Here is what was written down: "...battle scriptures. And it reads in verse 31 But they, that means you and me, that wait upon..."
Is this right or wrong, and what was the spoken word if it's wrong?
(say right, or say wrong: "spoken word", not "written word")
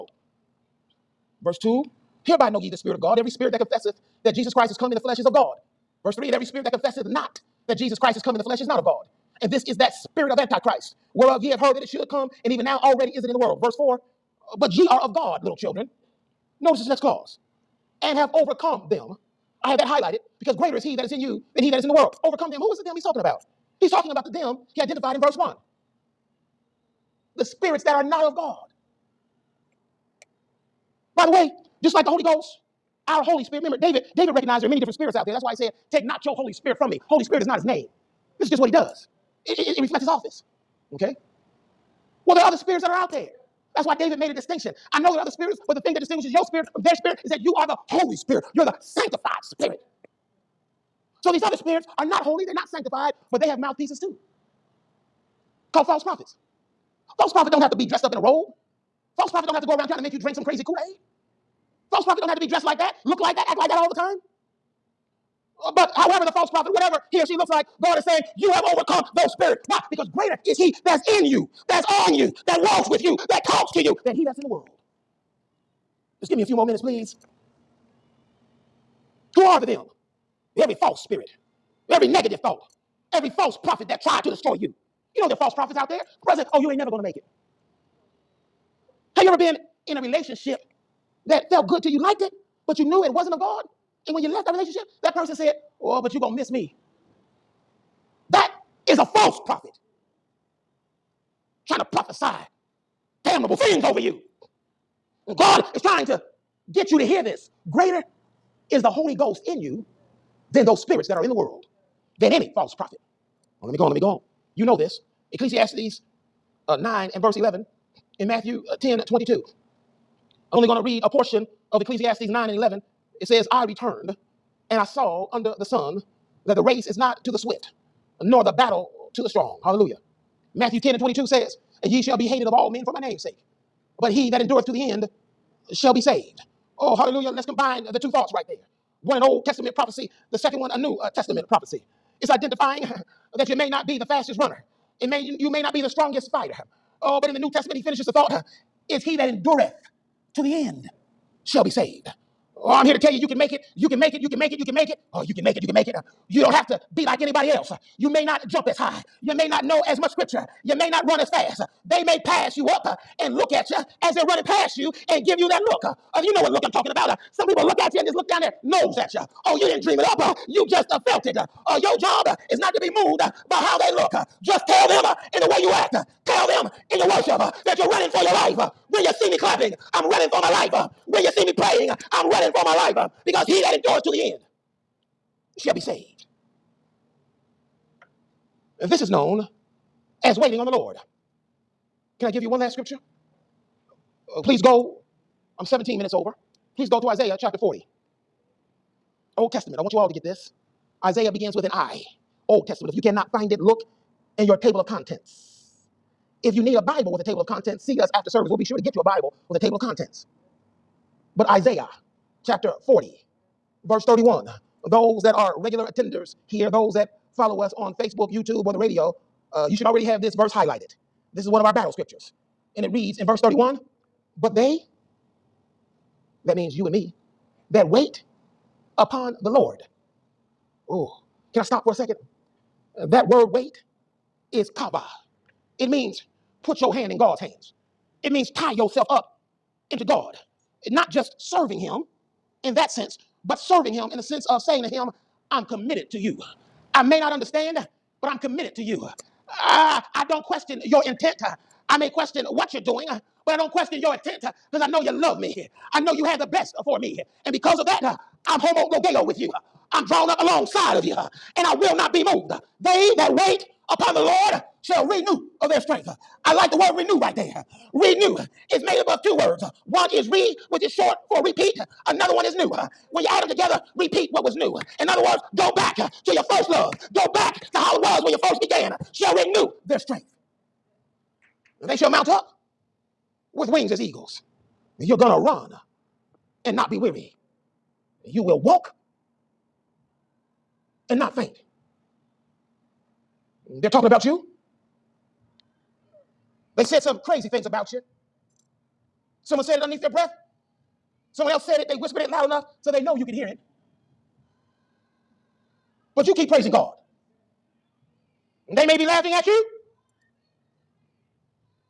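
right.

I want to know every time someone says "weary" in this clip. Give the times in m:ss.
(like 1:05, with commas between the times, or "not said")
4:46.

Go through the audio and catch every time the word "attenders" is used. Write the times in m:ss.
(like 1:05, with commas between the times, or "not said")
3:35.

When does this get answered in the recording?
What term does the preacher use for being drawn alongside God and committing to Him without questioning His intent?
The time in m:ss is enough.
4:18.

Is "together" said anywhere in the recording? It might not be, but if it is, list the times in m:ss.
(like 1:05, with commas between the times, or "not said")
4:33.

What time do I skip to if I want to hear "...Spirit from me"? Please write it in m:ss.
0:36.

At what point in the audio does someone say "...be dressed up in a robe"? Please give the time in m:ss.
0:57.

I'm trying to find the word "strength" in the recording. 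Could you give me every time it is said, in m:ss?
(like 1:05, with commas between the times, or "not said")
4:25, 4:39.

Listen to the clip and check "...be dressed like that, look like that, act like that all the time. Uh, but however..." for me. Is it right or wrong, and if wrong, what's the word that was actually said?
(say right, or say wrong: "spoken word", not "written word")
right.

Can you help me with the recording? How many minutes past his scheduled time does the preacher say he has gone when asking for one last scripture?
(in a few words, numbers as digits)
17.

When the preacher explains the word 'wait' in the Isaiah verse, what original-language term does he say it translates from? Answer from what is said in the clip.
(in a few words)
kava.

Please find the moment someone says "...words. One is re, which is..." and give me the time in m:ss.
4:29.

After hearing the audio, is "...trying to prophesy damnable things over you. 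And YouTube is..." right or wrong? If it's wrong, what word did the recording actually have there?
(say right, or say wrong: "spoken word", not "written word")
wrong: "God", not "YouTube".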